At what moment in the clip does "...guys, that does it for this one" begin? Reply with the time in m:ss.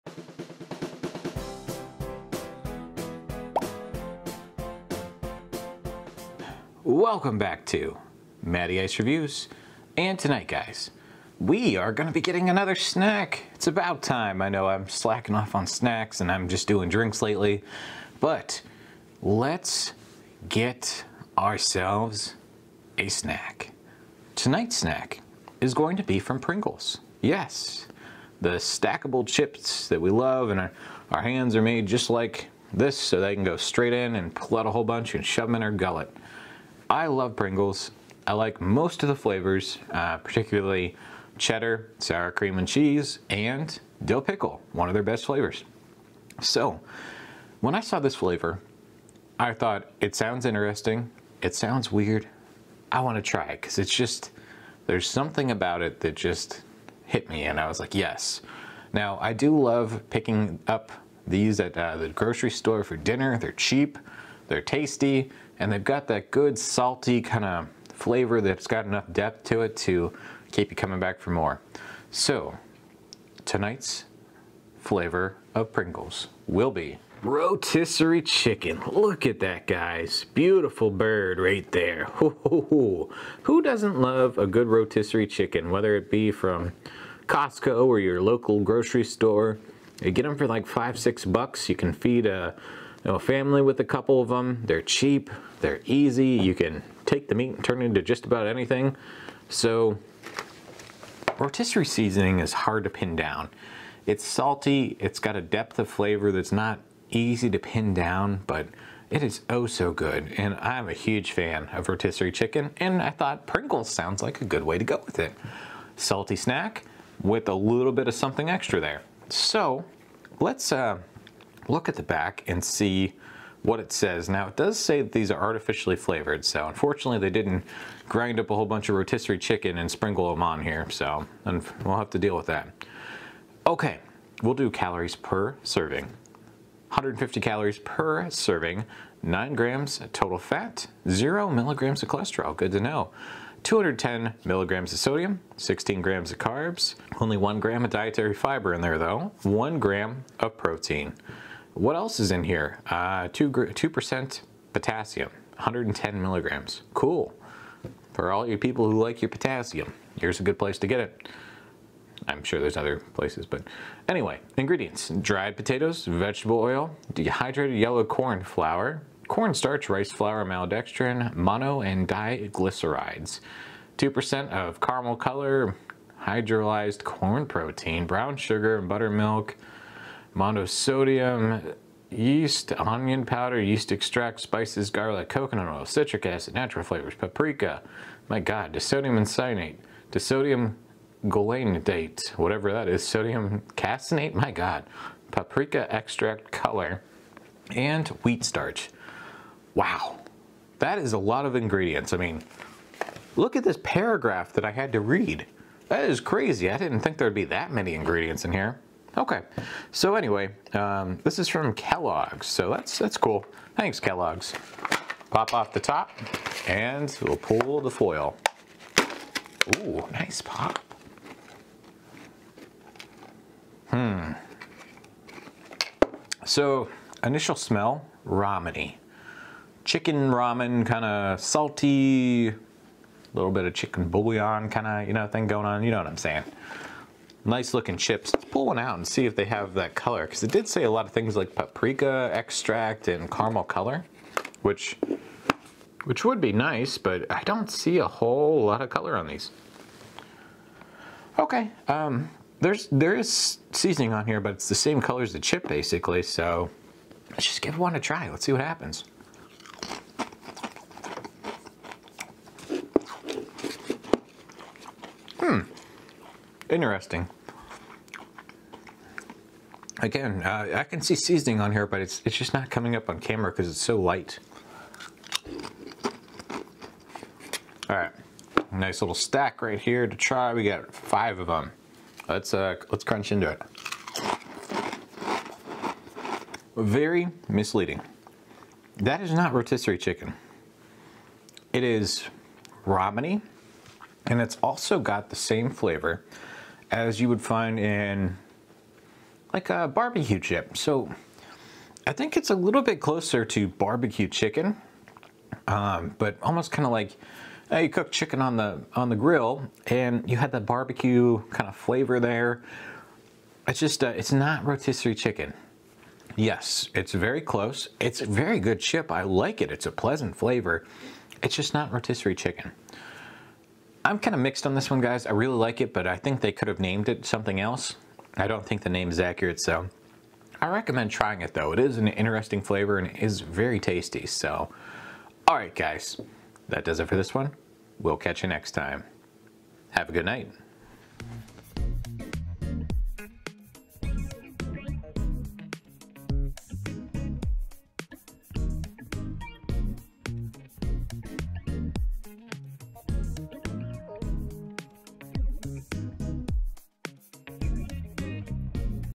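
5:35.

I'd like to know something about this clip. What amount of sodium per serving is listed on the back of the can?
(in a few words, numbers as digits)
210 milligrams.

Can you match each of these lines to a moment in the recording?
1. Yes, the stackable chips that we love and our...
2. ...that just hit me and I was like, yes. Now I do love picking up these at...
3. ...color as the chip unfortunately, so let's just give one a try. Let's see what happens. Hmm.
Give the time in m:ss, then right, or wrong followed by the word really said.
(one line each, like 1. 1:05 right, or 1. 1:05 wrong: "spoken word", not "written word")
1. 0:27 right
2. 0:56 right
3. 4:15 wrong: "basically", not "unfortunately".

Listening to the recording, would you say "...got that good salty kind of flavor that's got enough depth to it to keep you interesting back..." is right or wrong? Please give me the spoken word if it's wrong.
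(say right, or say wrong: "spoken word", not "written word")
wrong: "coming", not "interesting".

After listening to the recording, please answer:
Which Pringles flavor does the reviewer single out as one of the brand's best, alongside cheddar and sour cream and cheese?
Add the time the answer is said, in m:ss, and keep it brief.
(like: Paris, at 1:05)
dill pickle, at 0:44.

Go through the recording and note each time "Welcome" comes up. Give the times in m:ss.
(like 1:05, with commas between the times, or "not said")
0:06.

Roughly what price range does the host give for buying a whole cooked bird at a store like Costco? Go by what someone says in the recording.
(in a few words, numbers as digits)
5 to 6 bucks.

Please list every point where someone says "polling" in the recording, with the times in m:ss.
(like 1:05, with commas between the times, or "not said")
not said.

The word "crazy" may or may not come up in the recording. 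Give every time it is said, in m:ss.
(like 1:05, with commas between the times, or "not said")
3:26.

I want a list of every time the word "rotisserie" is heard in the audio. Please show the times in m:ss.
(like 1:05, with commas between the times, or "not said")
1:17, 1:24, 1:41, 1:51, 2:08, 4:49, 5:14, 5:21.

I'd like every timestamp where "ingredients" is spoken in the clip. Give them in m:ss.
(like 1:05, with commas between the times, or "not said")
2:44, 3:21, 3:27.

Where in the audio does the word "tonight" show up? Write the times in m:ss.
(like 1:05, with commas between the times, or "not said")
0:10, 0:24, 1:13.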